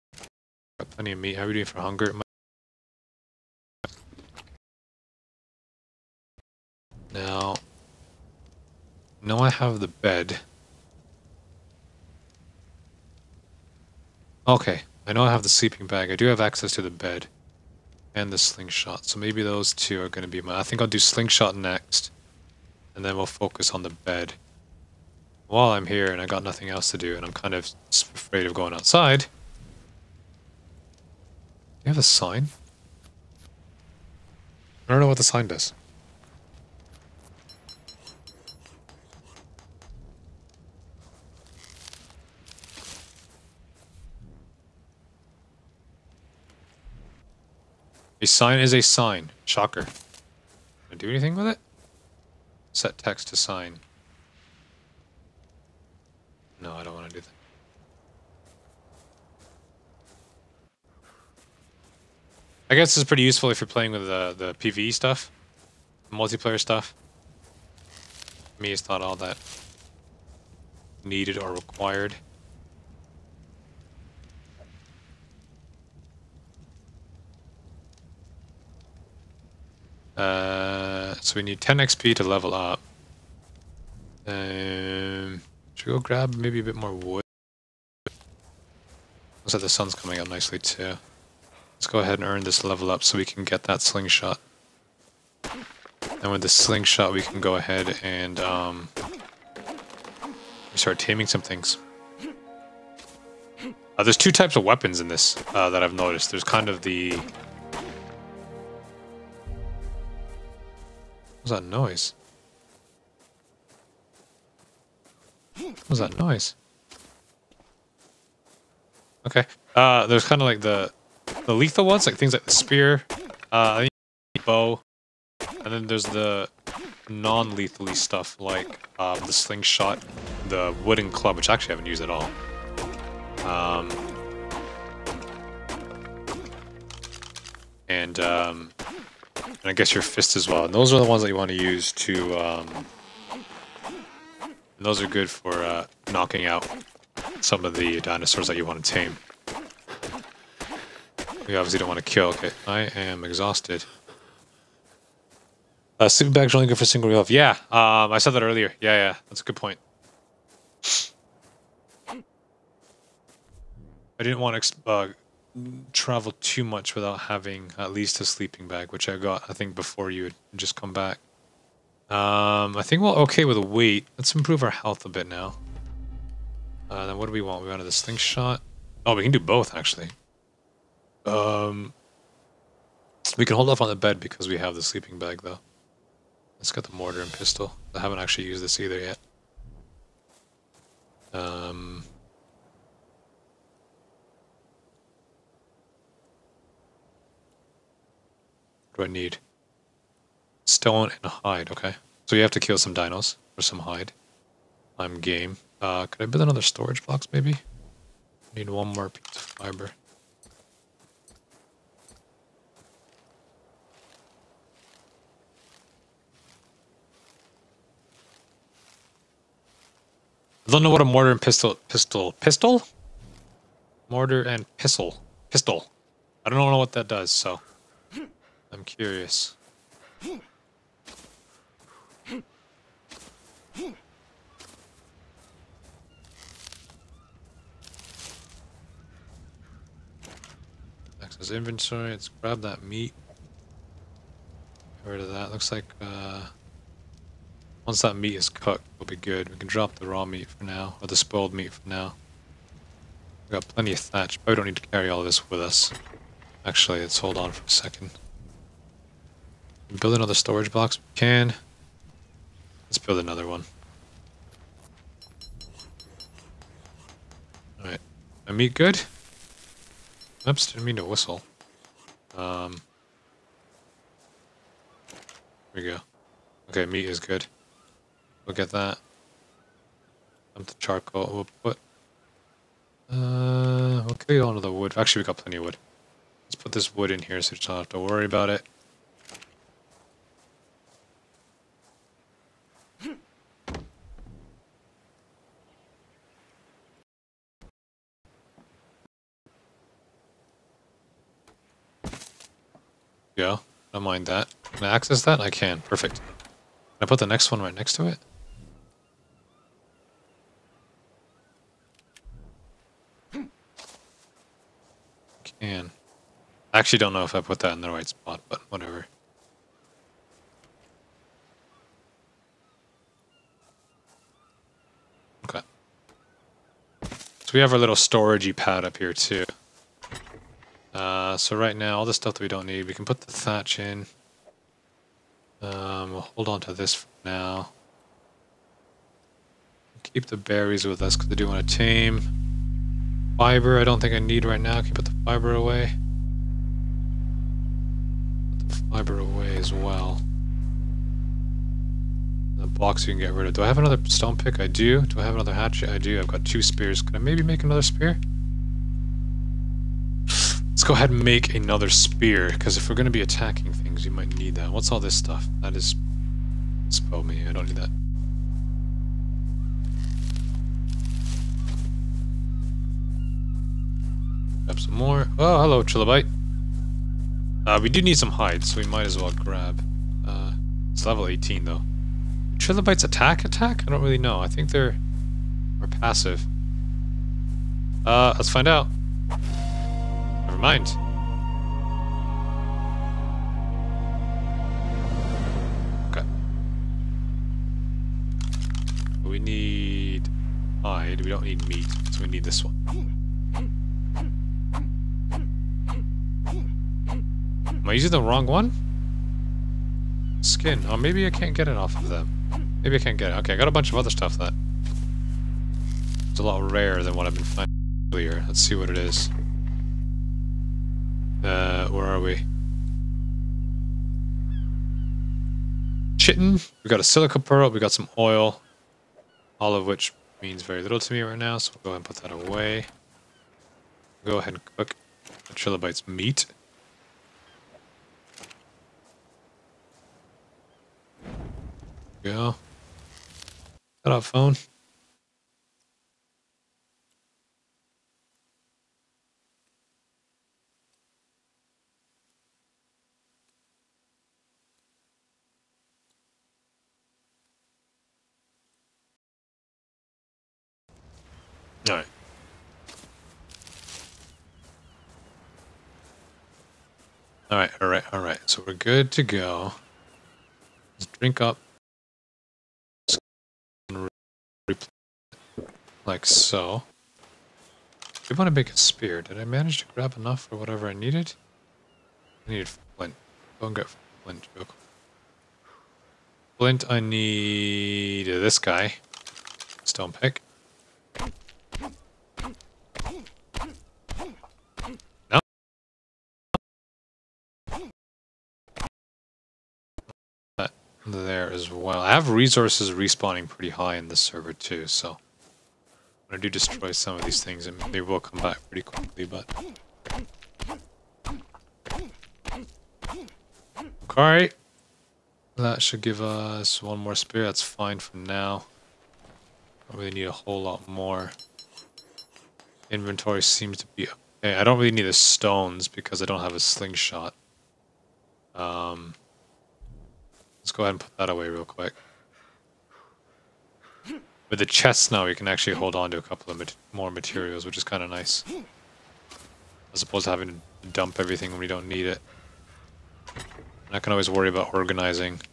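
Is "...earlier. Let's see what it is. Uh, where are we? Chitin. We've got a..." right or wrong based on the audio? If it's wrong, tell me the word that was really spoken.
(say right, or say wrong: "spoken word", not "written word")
right.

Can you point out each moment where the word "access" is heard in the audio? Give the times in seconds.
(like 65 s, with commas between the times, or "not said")
16 s, 241 s, 304 s.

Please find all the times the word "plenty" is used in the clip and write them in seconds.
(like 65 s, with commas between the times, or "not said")
0 s, 253 s, 285 s.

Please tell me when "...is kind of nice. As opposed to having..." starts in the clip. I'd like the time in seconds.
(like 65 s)
537 s.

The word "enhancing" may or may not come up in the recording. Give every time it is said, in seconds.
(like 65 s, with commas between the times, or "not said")
not said.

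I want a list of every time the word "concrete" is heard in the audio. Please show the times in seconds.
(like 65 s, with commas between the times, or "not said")
not said.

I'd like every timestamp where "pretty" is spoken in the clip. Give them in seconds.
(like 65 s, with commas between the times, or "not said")
63 s, 503 s, 508 s.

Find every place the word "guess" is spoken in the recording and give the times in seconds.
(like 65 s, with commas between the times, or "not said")
62 s, 139 s.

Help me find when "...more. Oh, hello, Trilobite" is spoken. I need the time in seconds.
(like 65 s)
374 s.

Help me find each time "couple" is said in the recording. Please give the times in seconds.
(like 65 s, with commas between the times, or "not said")
536 s.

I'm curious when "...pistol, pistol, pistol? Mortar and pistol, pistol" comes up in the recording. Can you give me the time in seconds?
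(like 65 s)
221 s.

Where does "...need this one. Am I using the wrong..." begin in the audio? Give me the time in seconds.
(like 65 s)
402 s.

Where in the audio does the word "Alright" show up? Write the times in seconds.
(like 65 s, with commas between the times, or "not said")
267 s, 514 s.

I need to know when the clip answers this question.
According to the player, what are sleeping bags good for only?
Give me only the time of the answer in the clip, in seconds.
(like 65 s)
156 s.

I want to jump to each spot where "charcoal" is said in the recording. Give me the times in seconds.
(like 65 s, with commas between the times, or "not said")
280 s.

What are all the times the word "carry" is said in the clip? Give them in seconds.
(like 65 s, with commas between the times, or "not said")
254 s, 284 s.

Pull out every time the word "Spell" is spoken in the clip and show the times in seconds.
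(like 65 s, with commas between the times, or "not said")
366 s.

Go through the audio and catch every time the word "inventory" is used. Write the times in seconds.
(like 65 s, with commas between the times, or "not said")
241 s, 522 s.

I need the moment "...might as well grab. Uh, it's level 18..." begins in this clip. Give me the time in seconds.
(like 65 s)
378 s.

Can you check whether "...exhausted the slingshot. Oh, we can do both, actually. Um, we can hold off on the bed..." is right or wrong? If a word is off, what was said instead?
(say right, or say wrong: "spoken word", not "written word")
wrong: "wanted", not "exhausted".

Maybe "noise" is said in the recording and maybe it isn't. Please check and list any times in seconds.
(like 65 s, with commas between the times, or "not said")
111 s, 116 s.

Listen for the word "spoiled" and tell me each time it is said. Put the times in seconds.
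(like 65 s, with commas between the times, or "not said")
251 s.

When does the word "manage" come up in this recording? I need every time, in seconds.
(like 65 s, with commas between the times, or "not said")
479 s.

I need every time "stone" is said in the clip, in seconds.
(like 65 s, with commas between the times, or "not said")
200 s, 354 s, 489 s, 525 s.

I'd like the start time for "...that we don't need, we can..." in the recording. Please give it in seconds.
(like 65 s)
332 s.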